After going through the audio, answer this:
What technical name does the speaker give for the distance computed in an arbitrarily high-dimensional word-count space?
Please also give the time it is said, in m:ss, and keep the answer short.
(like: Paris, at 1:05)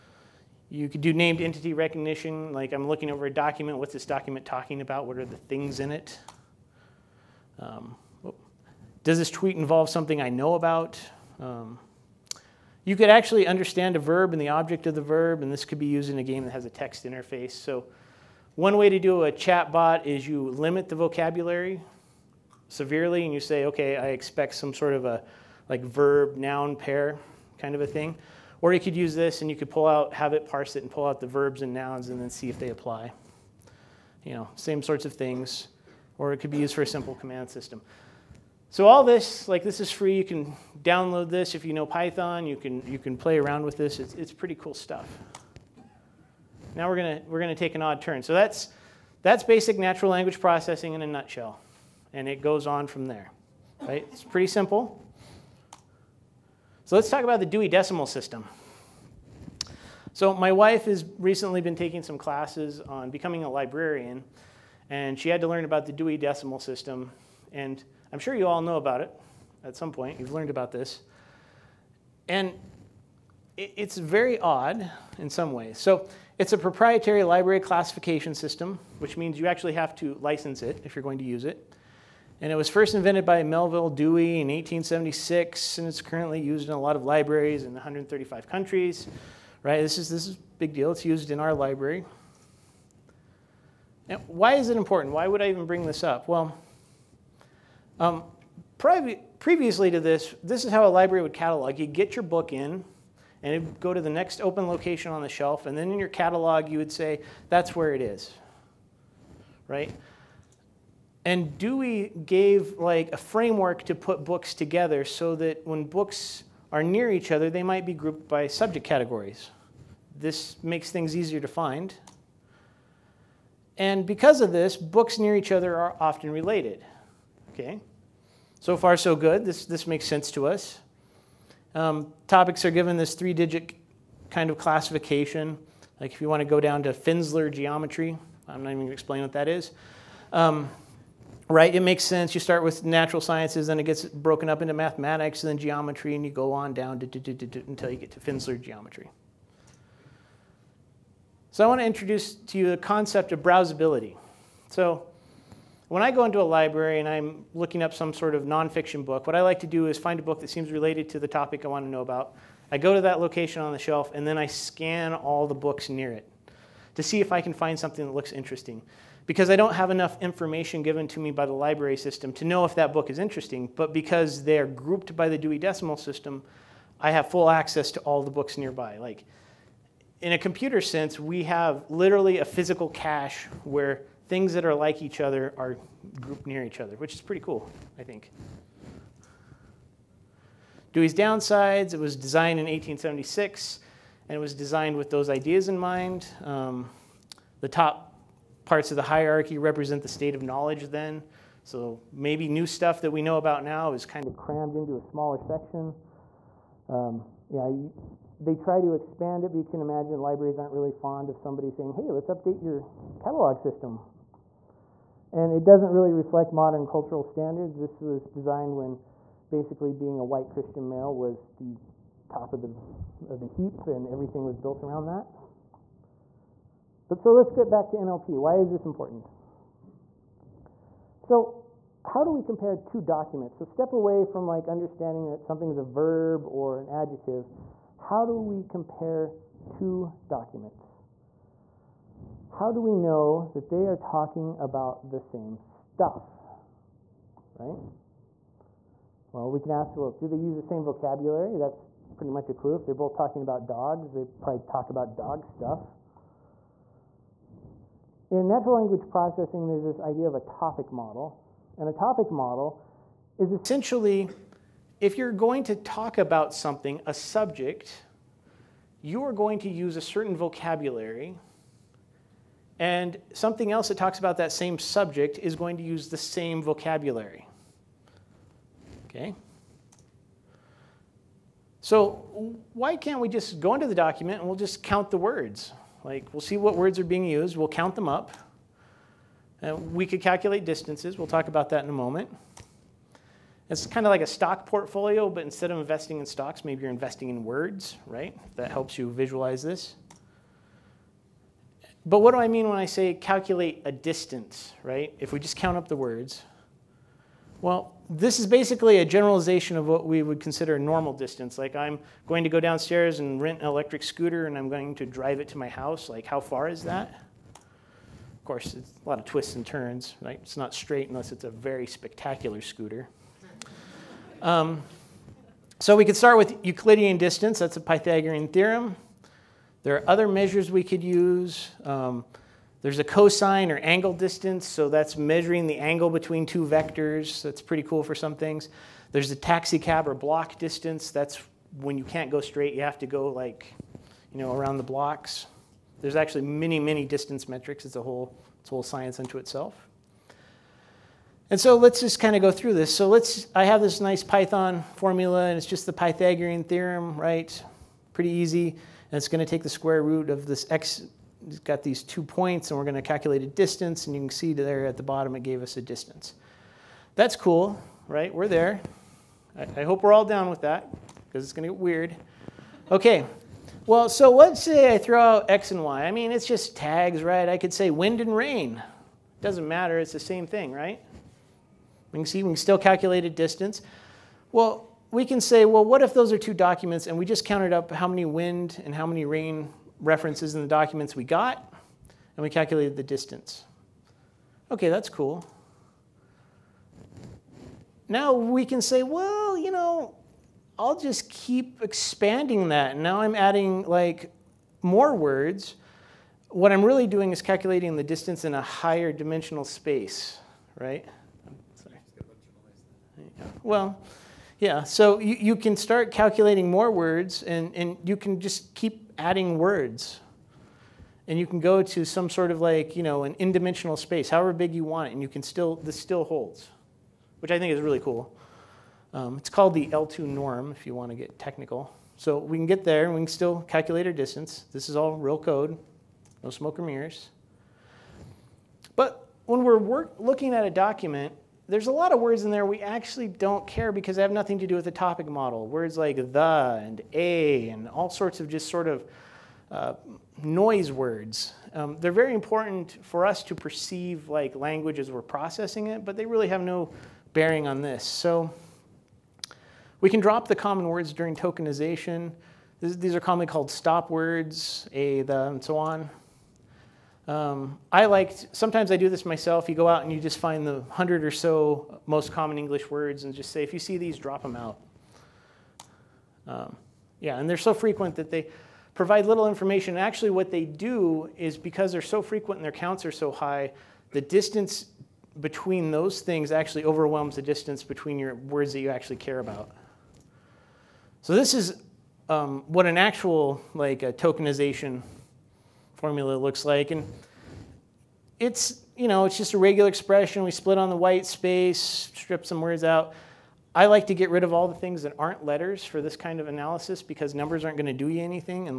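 L2 norm, at 7:09.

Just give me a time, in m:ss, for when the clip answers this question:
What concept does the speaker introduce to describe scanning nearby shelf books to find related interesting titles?
2:33.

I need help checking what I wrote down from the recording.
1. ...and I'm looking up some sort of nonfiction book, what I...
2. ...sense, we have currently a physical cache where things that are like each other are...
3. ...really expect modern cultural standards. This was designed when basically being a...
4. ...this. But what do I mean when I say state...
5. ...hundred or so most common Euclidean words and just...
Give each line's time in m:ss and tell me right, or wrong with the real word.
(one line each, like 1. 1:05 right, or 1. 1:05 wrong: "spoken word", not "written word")
1. 2:36 right
2. 3:00 wrong: "literally", not "currently"
3. 3:35 wrong: "reflect", not "expect"
4. 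4:59 wrong: "calculate", not "state"
5. 7:50 wrong: "English", not "Euclidean".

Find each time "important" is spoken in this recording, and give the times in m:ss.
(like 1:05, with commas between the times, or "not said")
1:34, 3:48, 7:32.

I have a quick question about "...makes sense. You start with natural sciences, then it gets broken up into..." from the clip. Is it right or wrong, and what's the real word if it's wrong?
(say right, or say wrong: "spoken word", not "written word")
right.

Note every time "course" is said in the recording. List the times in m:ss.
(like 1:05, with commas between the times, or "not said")
5:18.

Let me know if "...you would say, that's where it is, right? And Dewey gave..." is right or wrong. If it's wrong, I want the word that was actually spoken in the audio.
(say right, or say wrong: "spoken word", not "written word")
right.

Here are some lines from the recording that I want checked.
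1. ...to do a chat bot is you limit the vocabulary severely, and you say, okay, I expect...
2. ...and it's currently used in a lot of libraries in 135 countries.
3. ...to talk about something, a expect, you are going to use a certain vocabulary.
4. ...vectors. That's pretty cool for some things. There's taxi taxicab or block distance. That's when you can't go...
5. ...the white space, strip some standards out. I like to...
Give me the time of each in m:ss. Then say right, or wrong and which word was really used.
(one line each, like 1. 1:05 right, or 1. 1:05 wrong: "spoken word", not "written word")
1. 0:18 right
2. 1:25 right
3. 4:25 wrong: "subject", not "expect"
4. 5:36 right
5. 8:20 wrong: "words", not "standards".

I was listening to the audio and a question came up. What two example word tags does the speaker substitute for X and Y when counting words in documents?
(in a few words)
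Wind and rain.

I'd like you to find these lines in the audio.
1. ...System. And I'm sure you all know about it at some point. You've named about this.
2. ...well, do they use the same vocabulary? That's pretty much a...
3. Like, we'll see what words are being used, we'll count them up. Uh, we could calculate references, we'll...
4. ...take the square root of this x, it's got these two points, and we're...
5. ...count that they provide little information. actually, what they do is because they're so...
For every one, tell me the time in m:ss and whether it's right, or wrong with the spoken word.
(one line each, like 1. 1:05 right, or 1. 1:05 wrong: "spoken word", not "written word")
1. 1:06 wrong: "learned", not "named"
2. 4:09 right
3. 4:46 wrong: "distances", not "references"
4. 5:59 right
5. 7:57 wrong: "frequent", not "count".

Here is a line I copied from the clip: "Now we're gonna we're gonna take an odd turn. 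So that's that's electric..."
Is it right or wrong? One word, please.
wrong.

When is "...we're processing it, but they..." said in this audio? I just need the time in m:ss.
7:35.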